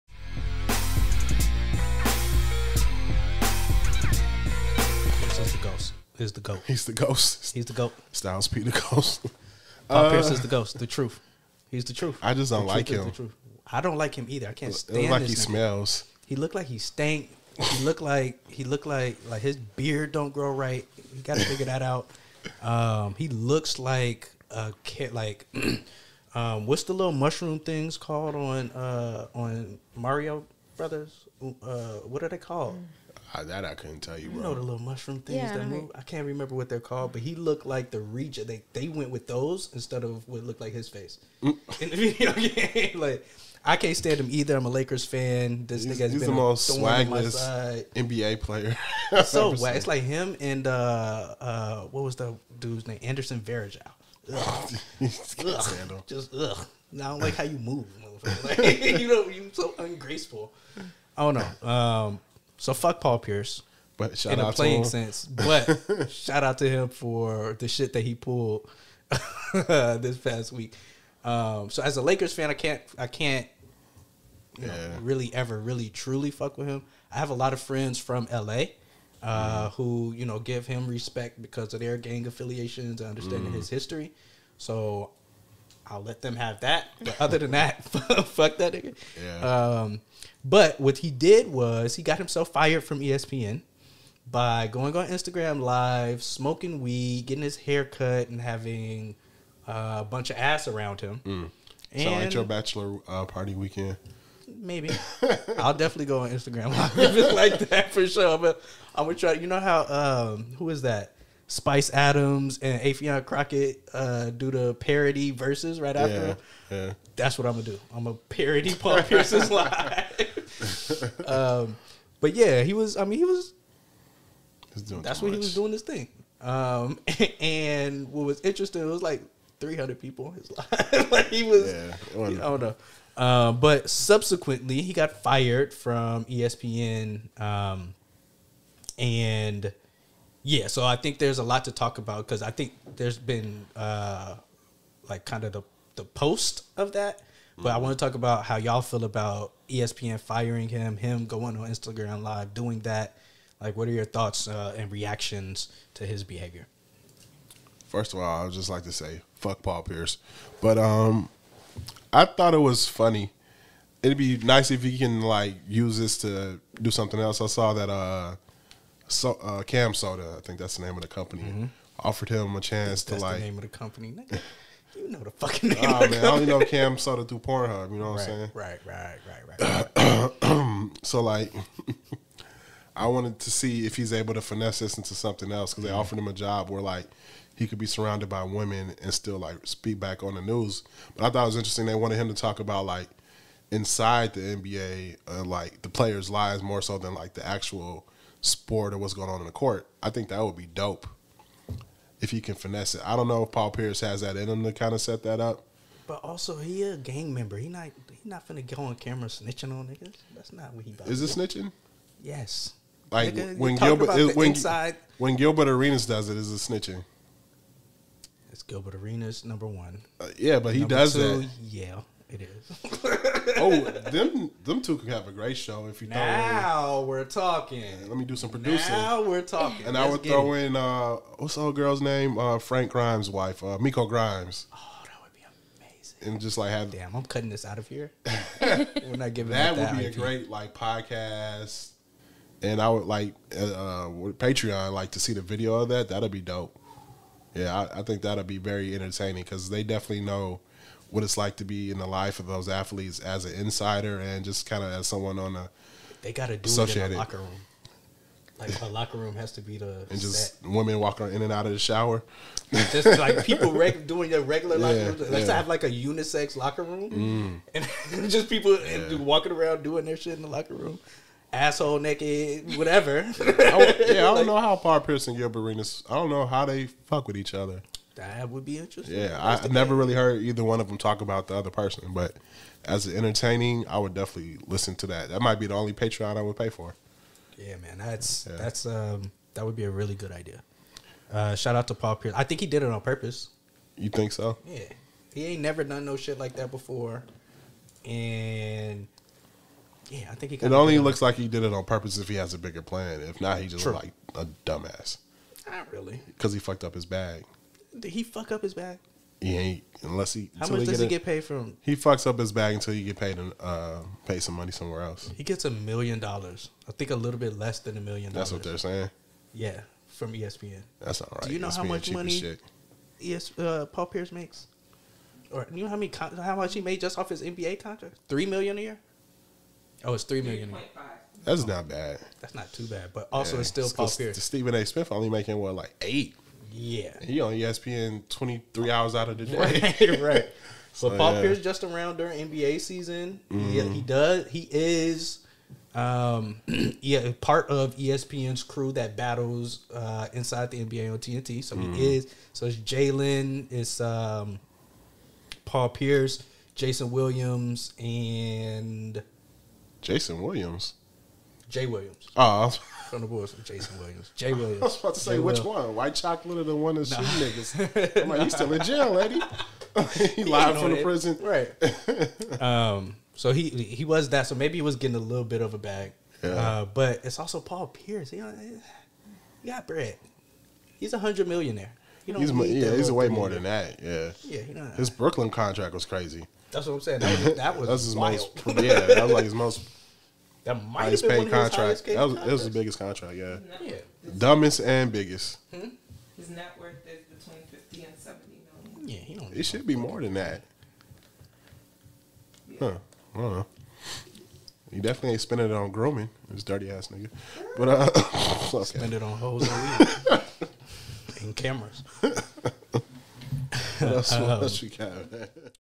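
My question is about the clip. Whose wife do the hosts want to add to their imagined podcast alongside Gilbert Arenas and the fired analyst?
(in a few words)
Miko Grimes.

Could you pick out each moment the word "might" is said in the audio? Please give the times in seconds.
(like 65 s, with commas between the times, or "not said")
285 s, 390 s.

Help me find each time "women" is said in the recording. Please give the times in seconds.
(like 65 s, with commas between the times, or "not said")
188 s, 260 s.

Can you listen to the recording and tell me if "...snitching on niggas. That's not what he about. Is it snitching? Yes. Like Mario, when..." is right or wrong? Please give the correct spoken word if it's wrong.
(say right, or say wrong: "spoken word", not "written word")
wrong: "Nigga", not "Mario".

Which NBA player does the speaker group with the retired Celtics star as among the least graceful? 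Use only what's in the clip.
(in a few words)
Anderson Varejao.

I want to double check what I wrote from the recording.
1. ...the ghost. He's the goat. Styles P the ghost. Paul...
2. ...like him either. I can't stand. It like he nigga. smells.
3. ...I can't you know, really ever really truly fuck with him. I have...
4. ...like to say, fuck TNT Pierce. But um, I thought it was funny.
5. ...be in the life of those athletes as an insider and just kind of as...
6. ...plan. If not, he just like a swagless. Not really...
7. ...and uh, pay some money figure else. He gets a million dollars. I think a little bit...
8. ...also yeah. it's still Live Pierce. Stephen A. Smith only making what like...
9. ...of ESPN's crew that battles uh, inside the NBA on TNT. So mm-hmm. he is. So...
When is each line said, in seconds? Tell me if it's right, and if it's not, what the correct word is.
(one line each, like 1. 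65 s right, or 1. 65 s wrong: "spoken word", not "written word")
1. 6 s right
2. 13 s right
3. 72 s right
4. 158 s wrong: "Paul", not "TNT"
5. 251 s right
6. 302 s wrong: "dumbass", not "swagless"
7. 313 s wrong: "somewhere", not "figure"
8. 333 s wrong: "Paul", not "Live"
9. 347 s right.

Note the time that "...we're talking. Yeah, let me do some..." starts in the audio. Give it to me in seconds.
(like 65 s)
227 s.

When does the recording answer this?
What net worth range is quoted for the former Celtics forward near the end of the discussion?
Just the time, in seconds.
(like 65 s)
397 s.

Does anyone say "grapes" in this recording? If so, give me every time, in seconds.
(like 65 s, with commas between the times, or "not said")
not said.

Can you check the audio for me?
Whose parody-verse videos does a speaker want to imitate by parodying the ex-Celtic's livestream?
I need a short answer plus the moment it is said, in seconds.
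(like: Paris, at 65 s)
Spice Adams and Affion Crockett, at 111 s.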